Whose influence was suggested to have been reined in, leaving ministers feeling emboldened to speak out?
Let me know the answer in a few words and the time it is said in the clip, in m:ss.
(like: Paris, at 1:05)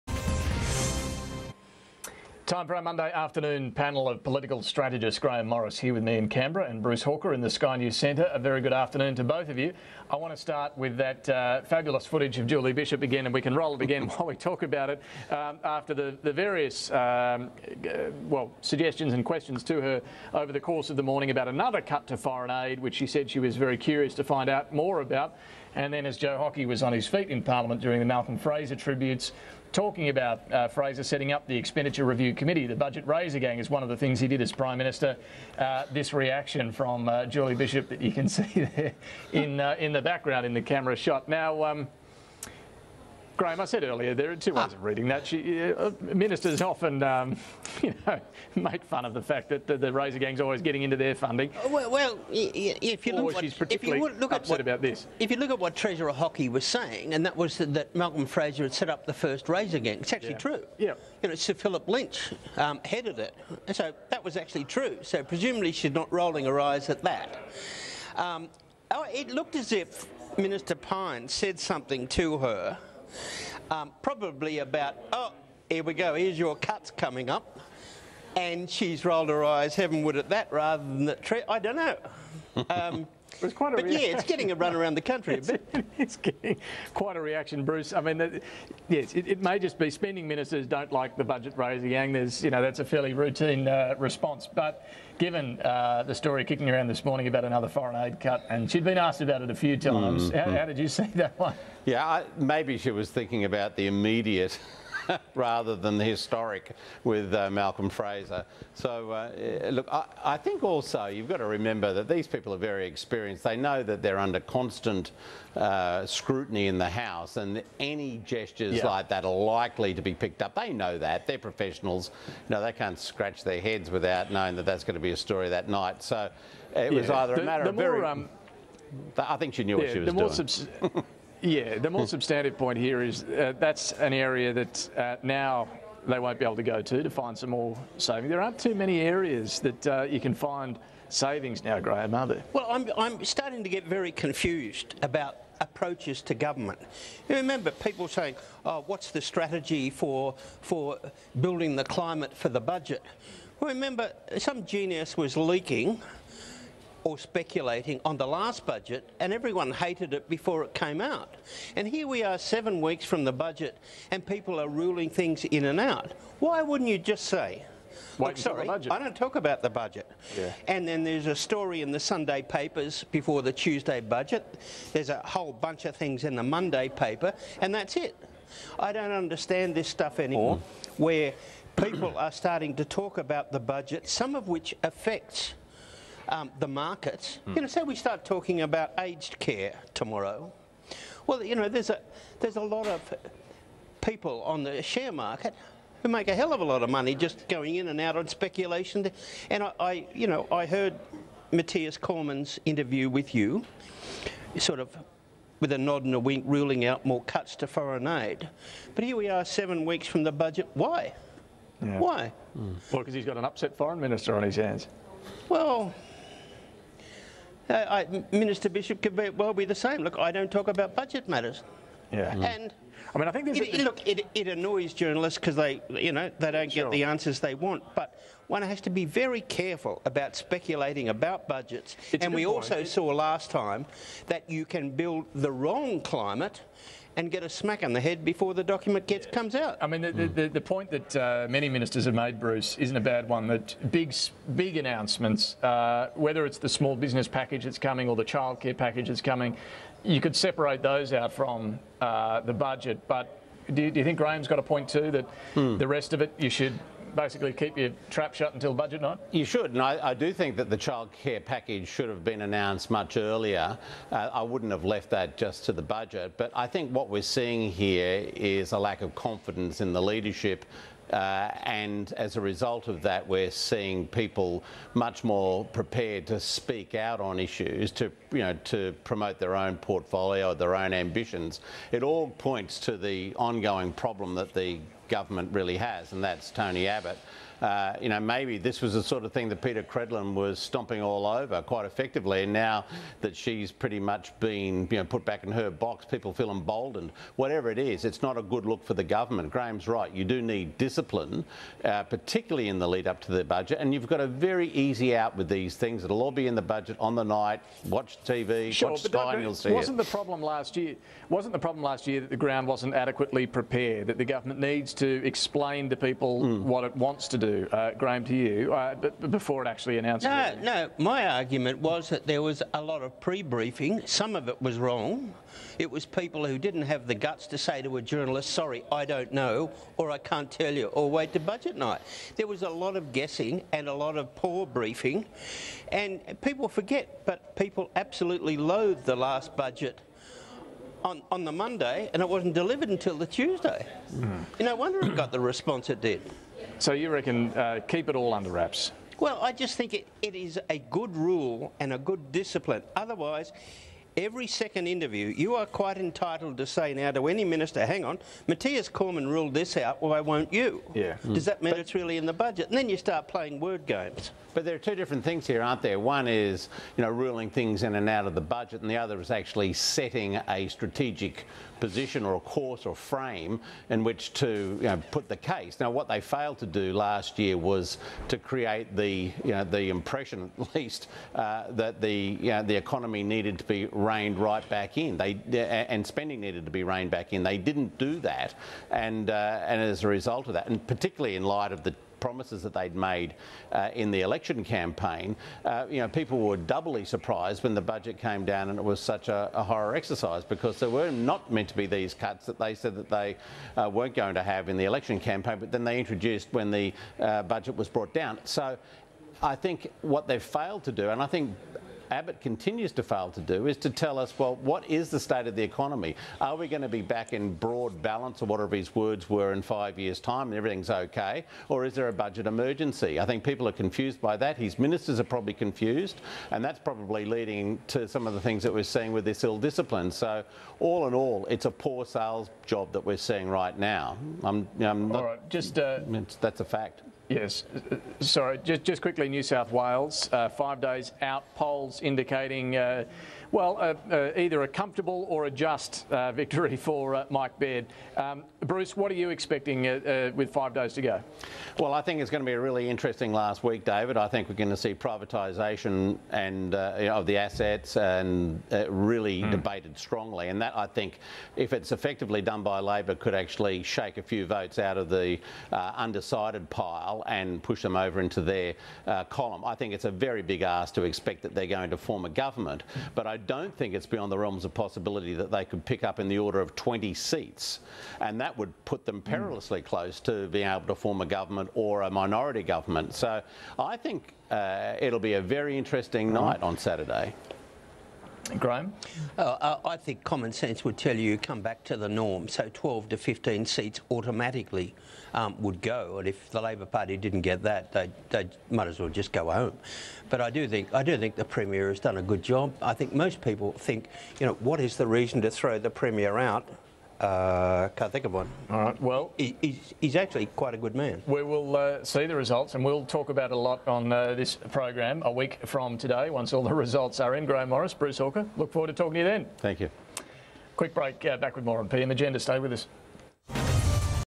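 Peta Credlin, at 4:49.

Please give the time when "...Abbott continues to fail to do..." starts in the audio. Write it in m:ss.
6:52.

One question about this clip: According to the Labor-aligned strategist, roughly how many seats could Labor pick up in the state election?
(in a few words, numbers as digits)
20.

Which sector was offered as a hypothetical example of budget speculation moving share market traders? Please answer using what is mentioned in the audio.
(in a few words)
aged care.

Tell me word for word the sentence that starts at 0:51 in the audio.
Uh, well, well if you look, or she's particularly if you look at upset what, about this.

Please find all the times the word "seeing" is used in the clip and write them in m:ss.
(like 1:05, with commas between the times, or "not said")
4:27, 4:33, 7:08, 7:13.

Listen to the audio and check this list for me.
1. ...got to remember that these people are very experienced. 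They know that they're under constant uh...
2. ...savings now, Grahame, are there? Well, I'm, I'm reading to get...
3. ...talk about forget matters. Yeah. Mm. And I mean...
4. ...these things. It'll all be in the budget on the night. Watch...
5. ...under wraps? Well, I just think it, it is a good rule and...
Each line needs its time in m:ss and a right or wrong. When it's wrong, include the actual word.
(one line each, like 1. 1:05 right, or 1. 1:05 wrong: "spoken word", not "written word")
1. 1:51 right
2. 2:21 wrong: "starting", not "reading"
3. 3:40 wrong: "budget", not "forget"
4. 5:05 right
5. 5:48 right.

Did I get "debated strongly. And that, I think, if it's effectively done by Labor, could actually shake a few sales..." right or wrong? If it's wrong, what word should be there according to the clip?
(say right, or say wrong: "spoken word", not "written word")
wrong: "votes", not "sales".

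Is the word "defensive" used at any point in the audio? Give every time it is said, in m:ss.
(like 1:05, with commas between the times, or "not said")
not said.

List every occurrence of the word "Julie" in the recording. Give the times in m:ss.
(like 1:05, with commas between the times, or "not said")
0:12, 0:37.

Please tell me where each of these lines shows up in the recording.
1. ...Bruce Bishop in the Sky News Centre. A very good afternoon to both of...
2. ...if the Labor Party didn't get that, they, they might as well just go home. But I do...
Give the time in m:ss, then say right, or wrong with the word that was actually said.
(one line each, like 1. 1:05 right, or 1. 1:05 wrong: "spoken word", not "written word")
1. 0:06 wrong: "Hawker", not "Bishop"
2. 8:16 right.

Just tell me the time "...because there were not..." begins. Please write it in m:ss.
6:40.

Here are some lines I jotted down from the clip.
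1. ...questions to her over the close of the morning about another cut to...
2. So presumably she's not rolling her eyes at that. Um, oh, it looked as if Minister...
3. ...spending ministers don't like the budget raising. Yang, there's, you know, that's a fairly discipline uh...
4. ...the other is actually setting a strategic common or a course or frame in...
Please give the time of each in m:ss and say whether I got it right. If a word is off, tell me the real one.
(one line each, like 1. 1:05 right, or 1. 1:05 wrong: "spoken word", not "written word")
1. 0:19 wrong: "course", not "close"
2. 1:05 right
3. 1:29 wrong: "routine", not "discipline"
4. 6:08 wrong: "position", not "common".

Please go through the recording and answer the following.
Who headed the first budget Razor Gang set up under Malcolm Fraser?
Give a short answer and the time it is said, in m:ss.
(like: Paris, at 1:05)
Sir Philip Lynch, at 1:01.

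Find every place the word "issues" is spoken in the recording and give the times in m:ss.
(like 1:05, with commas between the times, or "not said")
4:37.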